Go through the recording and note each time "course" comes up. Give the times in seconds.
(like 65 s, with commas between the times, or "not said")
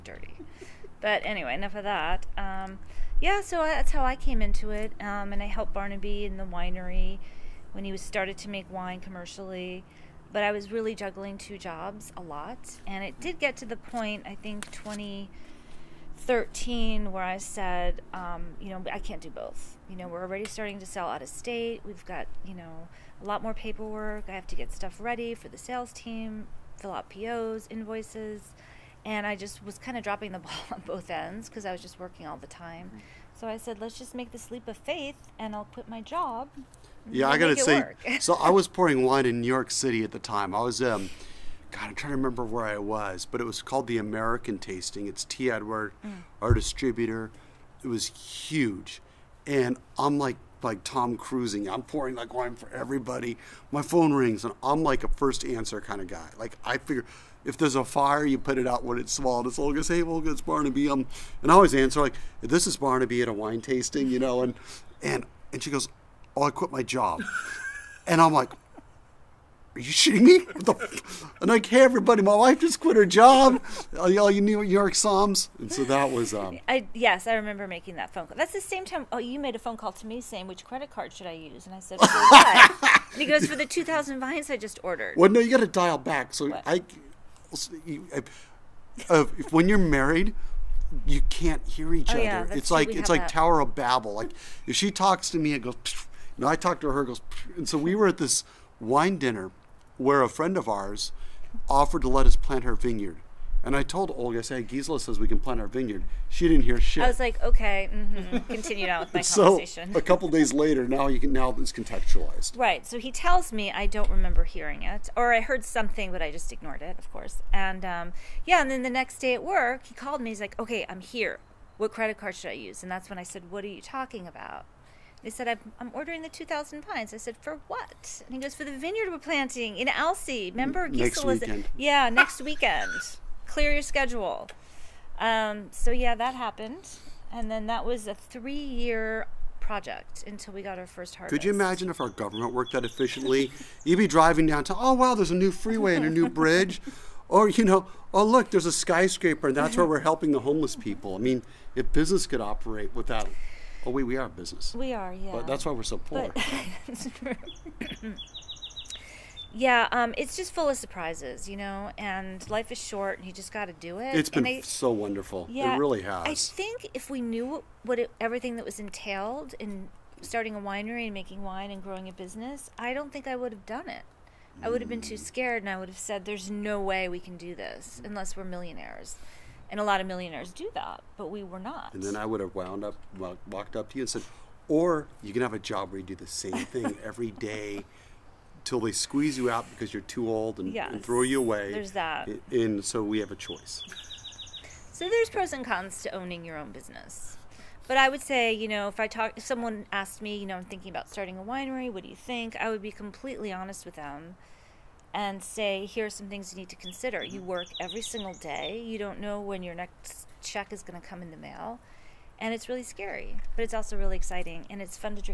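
117 s.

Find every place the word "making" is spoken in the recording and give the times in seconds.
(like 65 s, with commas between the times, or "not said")
77 s, 171 s.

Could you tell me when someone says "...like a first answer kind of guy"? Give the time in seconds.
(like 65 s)
54 s.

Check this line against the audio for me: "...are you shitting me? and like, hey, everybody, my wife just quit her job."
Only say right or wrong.
right.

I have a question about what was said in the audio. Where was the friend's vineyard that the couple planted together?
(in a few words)
Alsea.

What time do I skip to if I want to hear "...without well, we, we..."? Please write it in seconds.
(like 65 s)
152 s.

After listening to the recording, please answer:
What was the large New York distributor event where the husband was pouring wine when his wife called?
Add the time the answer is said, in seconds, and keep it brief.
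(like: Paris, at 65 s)
American Tasting, at 43 s.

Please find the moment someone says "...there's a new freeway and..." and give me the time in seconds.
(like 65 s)
145 s.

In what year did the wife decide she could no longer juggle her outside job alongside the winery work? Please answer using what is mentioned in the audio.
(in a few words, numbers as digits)
2013.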